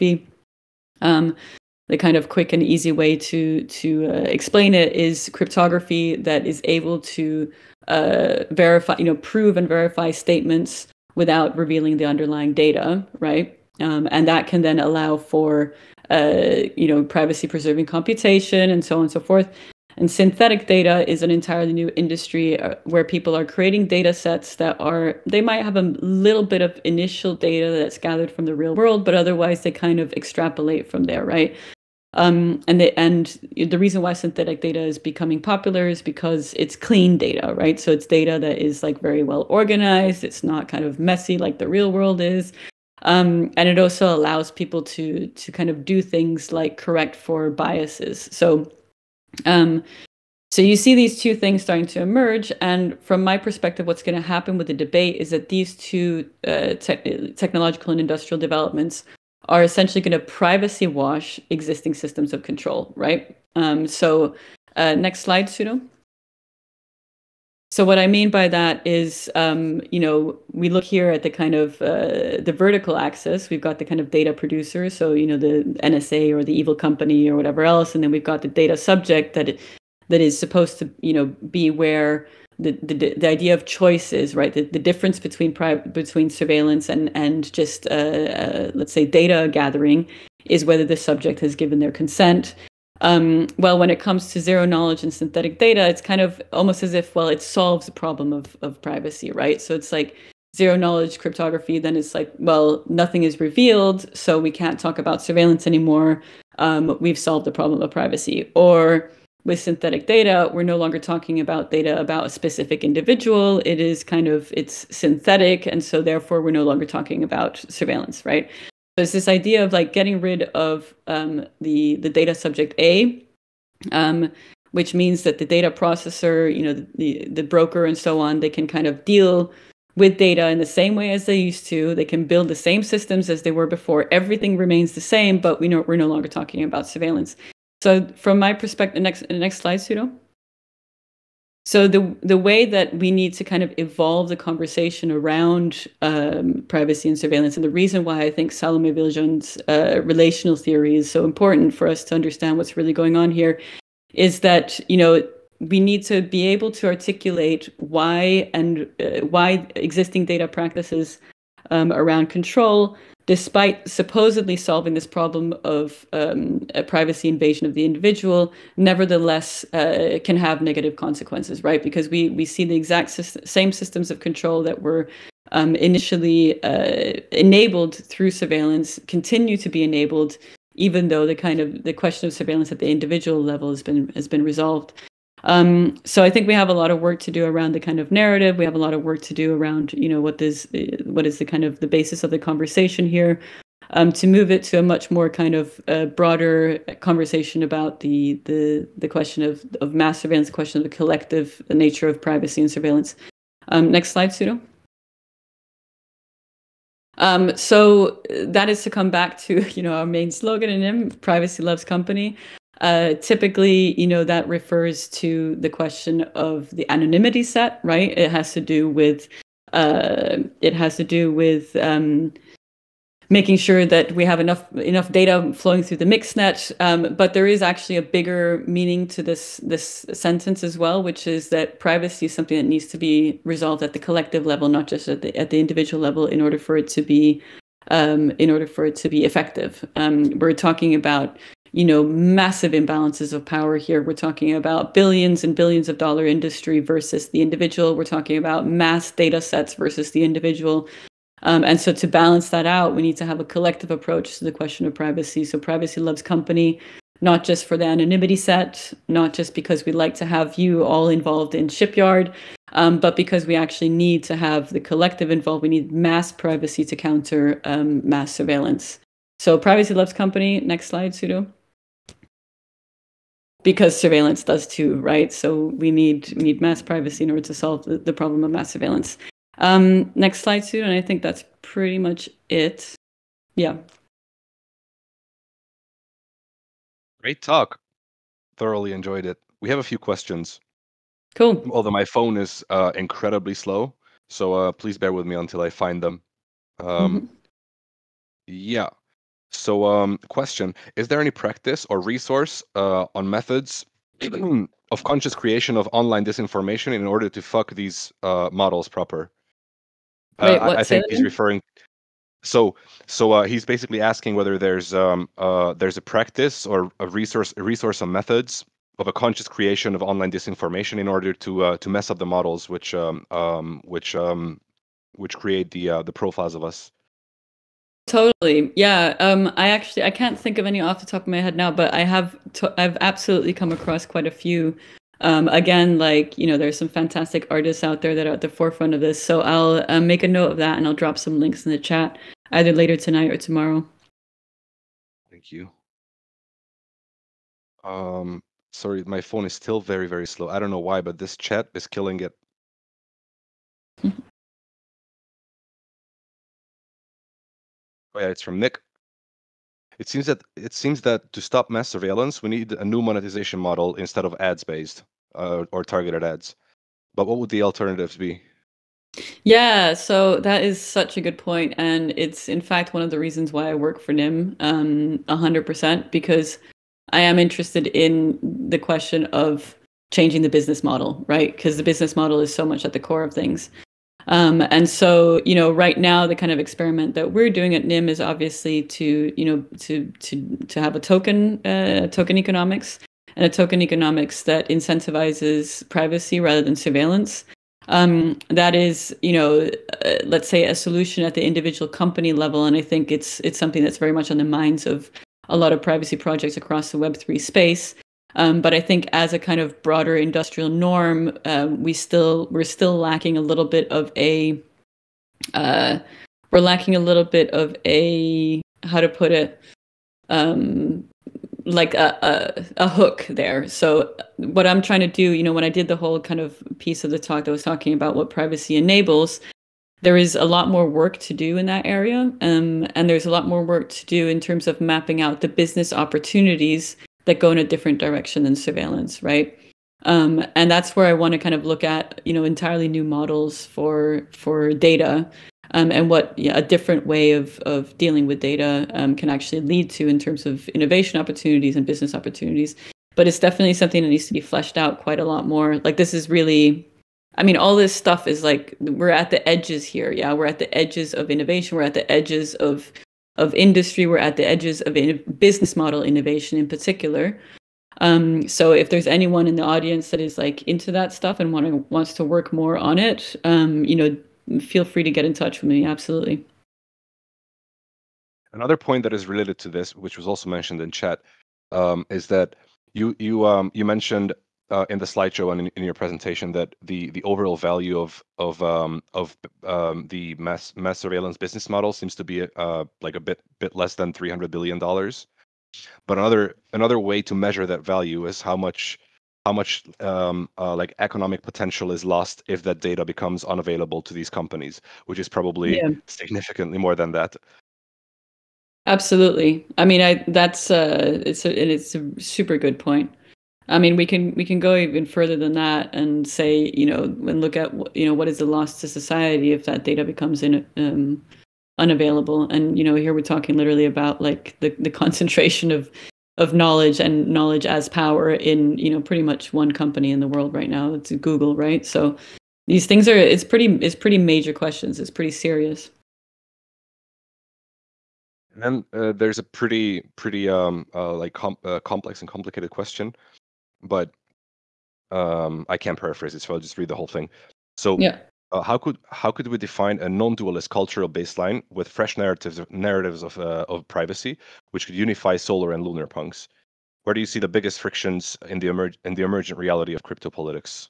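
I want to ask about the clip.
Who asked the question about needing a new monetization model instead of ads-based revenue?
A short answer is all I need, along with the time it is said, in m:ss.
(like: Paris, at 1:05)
Nick, at 5:58.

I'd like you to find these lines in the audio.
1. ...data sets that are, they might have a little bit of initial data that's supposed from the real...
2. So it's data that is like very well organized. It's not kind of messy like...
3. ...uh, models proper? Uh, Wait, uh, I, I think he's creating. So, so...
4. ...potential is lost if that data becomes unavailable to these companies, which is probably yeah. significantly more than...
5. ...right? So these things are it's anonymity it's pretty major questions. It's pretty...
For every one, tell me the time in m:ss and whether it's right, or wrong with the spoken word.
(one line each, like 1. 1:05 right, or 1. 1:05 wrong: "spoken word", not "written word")
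1. 0:23 wrong: "gathered", not "supposed"
2. 0:37 right
3. 5:08 wrong: "referring", not "creating"
4. 8:21 right
5. 8:51 wrong: "pretty", not "anonymity".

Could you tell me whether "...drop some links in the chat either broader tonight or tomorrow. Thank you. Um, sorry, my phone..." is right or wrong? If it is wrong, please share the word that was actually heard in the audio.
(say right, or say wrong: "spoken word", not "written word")
wrong: "later", not "broader".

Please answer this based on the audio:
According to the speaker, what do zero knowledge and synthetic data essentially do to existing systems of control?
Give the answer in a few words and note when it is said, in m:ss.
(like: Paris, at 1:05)
privacy wash, at 1:00.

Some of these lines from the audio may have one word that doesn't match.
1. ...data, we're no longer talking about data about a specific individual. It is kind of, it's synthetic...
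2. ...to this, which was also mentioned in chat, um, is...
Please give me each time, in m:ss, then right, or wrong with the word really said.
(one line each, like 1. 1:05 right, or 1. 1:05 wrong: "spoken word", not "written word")
1. 1:50 right
2. 7:59 right.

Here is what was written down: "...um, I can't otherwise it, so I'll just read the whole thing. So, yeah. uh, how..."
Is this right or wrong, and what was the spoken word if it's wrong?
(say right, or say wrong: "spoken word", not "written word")
wrong: "paraphrase", not "otherwise".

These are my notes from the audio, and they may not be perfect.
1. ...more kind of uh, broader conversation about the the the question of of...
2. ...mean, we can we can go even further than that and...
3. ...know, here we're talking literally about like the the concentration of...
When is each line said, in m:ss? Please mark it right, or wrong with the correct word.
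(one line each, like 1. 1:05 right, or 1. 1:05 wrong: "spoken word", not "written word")
1. 3:15 right
2. 8:33 right
3. 8:42 right.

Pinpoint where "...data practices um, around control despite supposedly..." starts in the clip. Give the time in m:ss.
2:40.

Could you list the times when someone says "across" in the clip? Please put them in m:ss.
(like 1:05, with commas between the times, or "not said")
5:33, 6:46.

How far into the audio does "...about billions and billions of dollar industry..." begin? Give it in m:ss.
4:04.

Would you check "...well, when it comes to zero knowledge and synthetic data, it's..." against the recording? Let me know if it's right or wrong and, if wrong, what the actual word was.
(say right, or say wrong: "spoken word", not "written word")
right.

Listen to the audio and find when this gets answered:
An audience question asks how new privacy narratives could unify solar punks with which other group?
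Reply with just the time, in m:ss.
9:15.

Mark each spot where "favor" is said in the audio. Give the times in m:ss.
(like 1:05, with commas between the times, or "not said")
not said.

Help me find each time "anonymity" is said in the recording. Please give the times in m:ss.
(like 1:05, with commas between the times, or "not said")
3:36, 4:17.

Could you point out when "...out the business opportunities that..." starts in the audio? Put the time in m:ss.
7:15.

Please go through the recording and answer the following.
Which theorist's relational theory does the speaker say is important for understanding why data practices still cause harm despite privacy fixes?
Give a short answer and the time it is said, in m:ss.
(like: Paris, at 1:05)
Salome Viljoen, at 2:28.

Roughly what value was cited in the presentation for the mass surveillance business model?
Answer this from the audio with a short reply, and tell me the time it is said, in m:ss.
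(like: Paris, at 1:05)
$300 billion, at 8:14.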